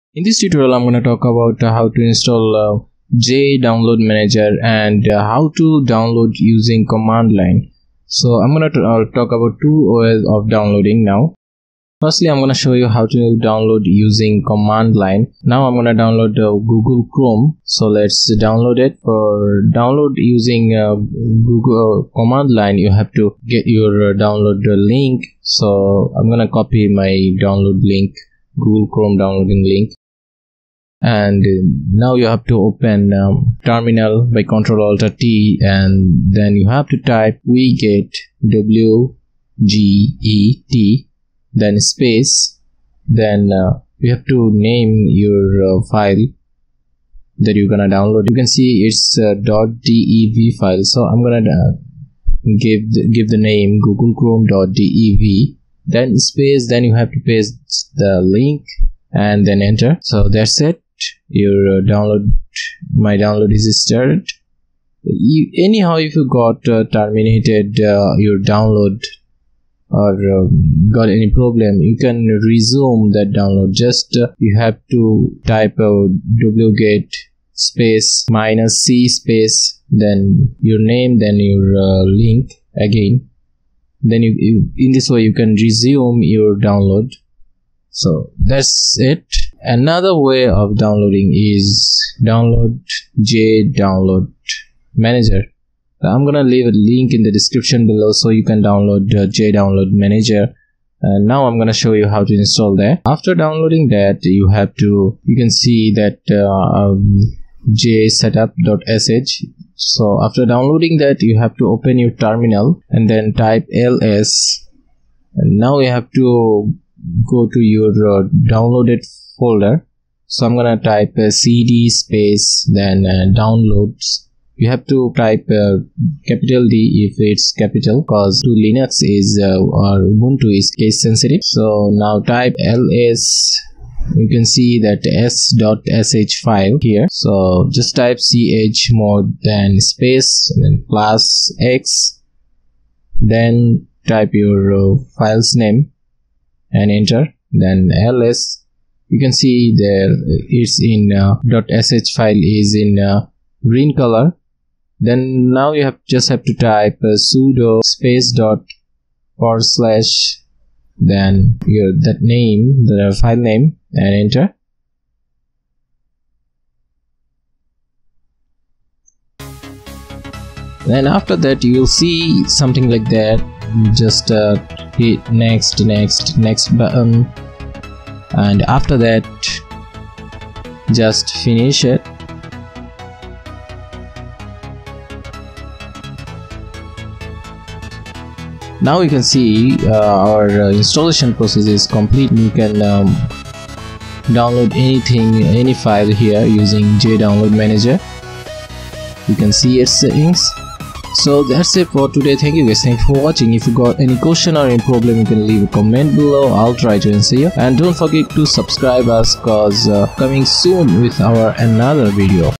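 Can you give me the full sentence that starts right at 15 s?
Now I'm going to download uh, Google Chrome.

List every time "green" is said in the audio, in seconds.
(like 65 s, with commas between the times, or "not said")
153 s.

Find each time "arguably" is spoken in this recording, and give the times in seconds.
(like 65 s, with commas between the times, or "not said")
not said.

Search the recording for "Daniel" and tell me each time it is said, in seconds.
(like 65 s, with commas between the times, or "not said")
not said.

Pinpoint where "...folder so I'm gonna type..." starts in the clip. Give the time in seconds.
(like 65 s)
119 s.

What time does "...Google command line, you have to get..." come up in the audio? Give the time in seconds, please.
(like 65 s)
20 s.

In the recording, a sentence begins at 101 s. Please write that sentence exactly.
And now I'm gonna show you how to install that.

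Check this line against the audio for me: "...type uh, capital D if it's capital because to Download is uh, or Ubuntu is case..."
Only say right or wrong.
wrong.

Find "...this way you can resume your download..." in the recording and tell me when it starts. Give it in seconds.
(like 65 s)
84 s.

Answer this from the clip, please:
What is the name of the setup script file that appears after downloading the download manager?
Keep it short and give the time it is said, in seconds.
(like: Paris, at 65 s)
jsetup.sh, at 107 s.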